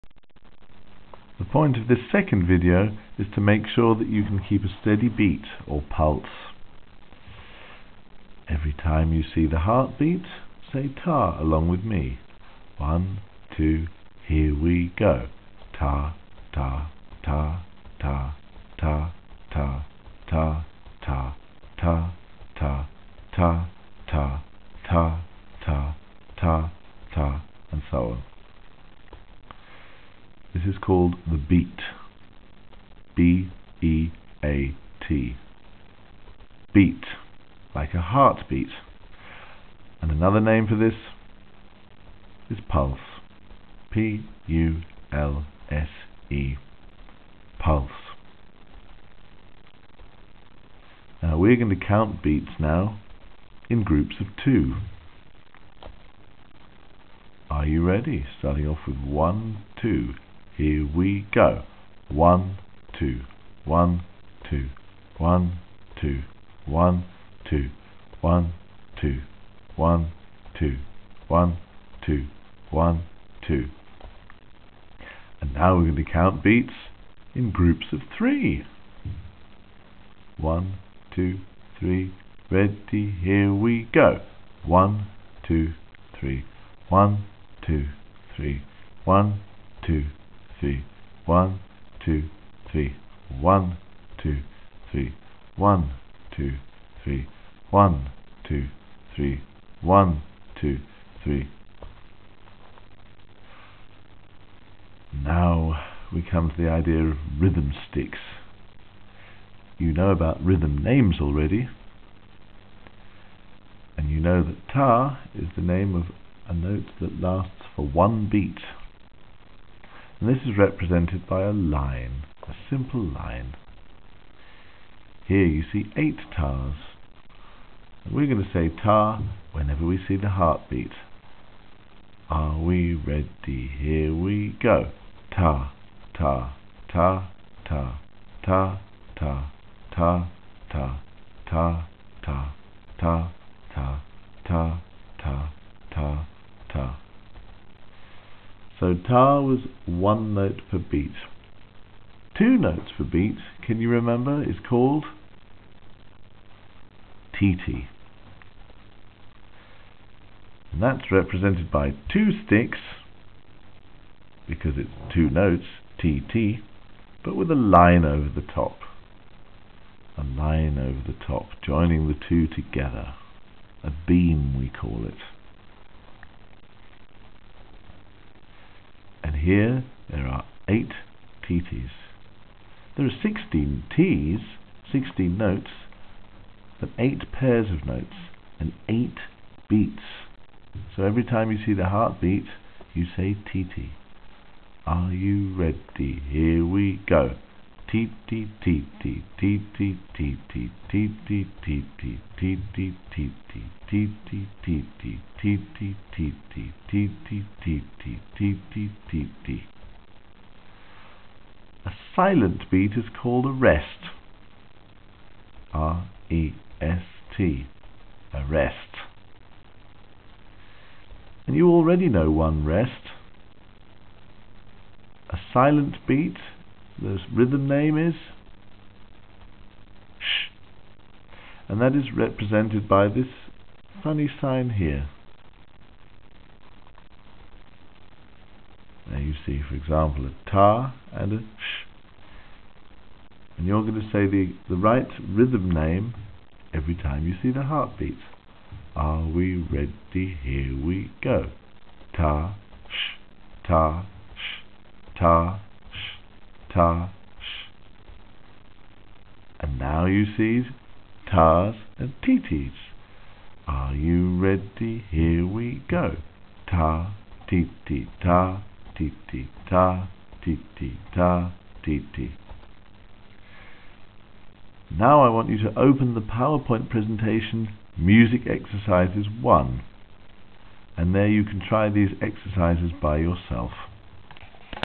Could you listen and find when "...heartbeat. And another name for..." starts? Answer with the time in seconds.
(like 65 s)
38 s.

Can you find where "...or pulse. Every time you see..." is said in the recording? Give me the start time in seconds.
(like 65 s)
5 s.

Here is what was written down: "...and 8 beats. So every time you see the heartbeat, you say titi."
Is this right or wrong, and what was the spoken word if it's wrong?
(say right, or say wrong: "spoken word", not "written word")
right.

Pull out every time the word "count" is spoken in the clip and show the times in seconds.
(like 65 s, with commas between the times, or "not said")
51 s, 76 s.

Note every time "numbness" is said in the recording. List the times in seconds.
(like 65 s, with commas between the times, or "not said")
not said.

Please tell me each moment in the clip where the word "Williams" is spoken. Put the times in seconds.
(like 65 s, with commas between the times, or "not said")
not said.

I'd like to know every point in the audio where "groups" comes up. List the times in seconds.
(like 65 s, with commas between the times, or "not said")
53 s, 77 s.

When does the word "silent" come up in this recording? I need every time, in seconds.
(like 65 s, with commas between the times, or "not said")
212 s, 225 s.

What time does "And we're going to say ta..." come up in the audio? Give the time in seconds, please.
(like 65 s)
128 s.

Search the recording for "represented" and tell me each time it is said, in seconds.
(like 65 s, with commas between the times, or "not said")
120 s, 161 s, 232 s.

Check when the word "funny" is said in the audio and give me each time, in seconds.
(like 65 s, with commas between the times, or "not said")
234 s.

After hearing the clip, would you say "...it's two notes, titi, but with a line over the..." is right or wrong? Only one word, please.
right.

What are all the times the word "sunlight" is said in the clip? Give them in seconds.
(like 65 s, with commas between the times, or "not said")
not said.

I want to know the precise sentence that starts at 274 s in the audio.
Now I want you to open the PowerPoint presentation Music Exercises 1 and there you can try these exercises by yourself.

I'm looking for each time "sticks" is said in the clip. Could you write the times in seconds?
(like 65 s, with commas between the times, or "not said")
107 s, 162 s.